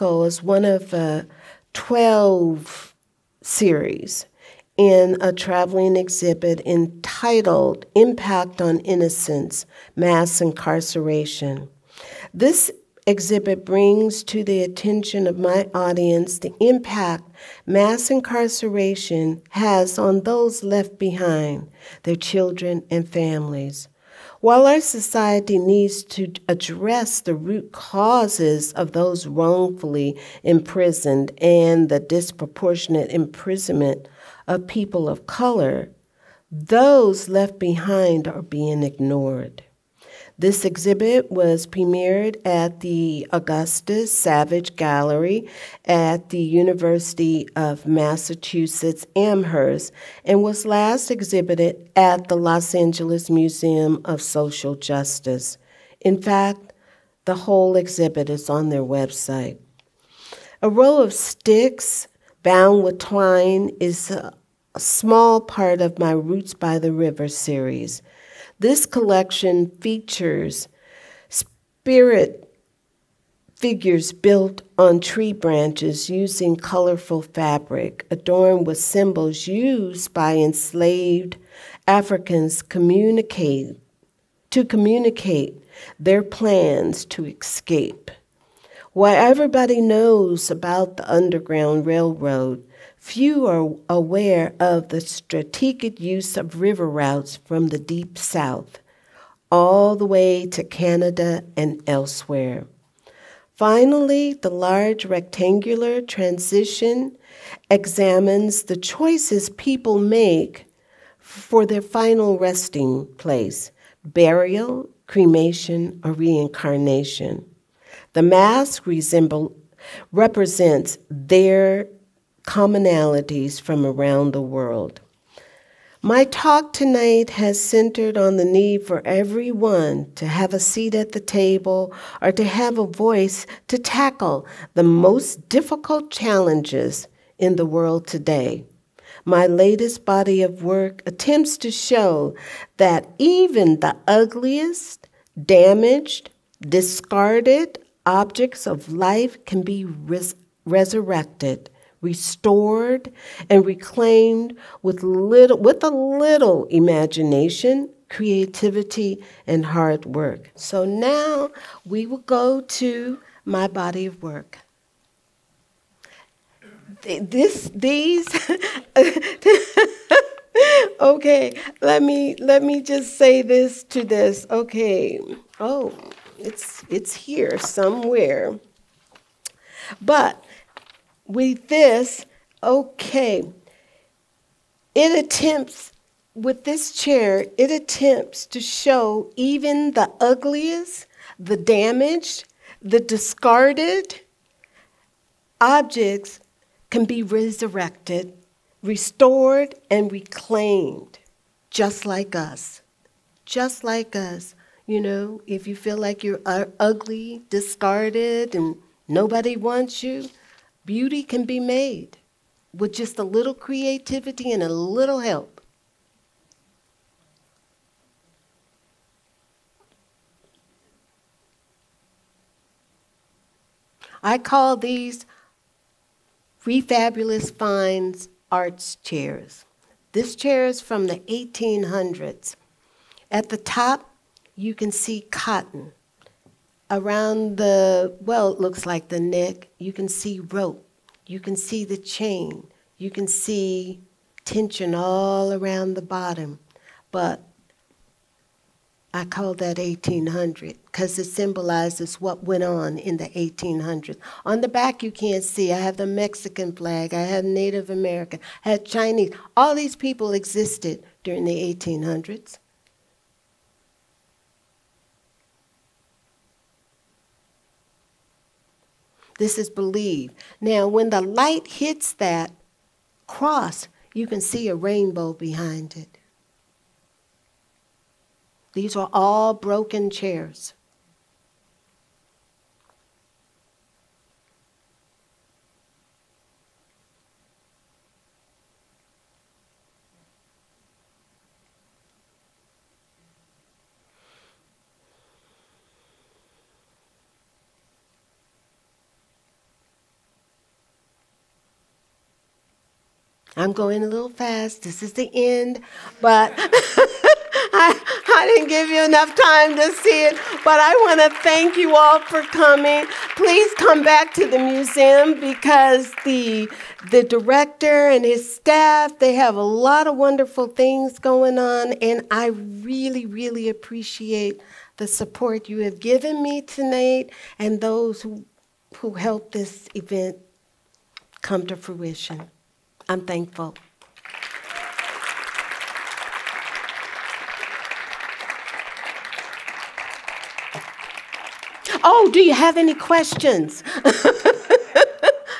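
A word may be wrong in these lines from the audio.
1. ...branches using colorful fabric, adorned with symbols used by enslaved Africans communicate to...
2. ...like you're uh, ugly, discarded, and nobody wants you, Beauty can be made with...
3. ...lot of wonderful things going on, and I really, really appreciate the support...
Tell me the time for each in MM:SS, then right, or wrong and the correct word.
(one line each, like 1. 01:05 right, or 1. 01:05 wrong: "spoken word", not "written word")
1. 01:15 right
2. 03:25 right
3. 05:19 right.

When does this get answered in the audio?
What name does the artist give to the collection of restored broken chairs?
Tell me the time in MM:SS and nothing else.
03:46.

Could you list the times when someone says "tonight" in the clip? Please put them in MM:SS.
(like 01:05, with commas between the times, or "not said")
02:06, 05:26.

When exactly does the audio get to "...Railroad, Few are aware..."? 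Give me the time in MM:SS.
01:31.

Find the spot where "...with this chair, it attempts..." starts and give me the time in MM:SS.
03:06.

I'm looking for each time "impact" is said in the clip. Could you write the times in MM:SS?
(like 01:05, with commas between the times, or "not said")
00:07, 00:16.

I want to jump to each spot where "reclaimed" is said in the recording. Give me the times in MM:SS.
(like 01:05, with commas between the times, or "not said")
02:33, 03:20.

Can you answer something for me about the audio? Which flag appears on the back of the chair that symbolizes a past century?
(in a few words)
Mexican flag.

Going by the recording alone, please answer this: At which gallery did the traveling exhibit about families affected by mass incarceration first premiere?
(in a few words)
Augusta Savage Gallery.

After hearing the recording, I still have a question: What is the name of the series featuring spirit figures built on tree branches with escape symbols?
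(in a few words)
Roots by the River.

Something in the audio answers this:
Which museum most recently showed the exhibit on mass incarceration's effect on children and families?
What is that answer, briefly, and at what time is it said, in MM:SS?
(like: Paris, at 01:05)
Los Angeles Museum of Social Justice, at 00:52.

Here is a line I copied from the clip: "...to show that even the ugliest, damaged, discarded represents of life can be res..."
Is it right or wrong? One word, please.
wrong.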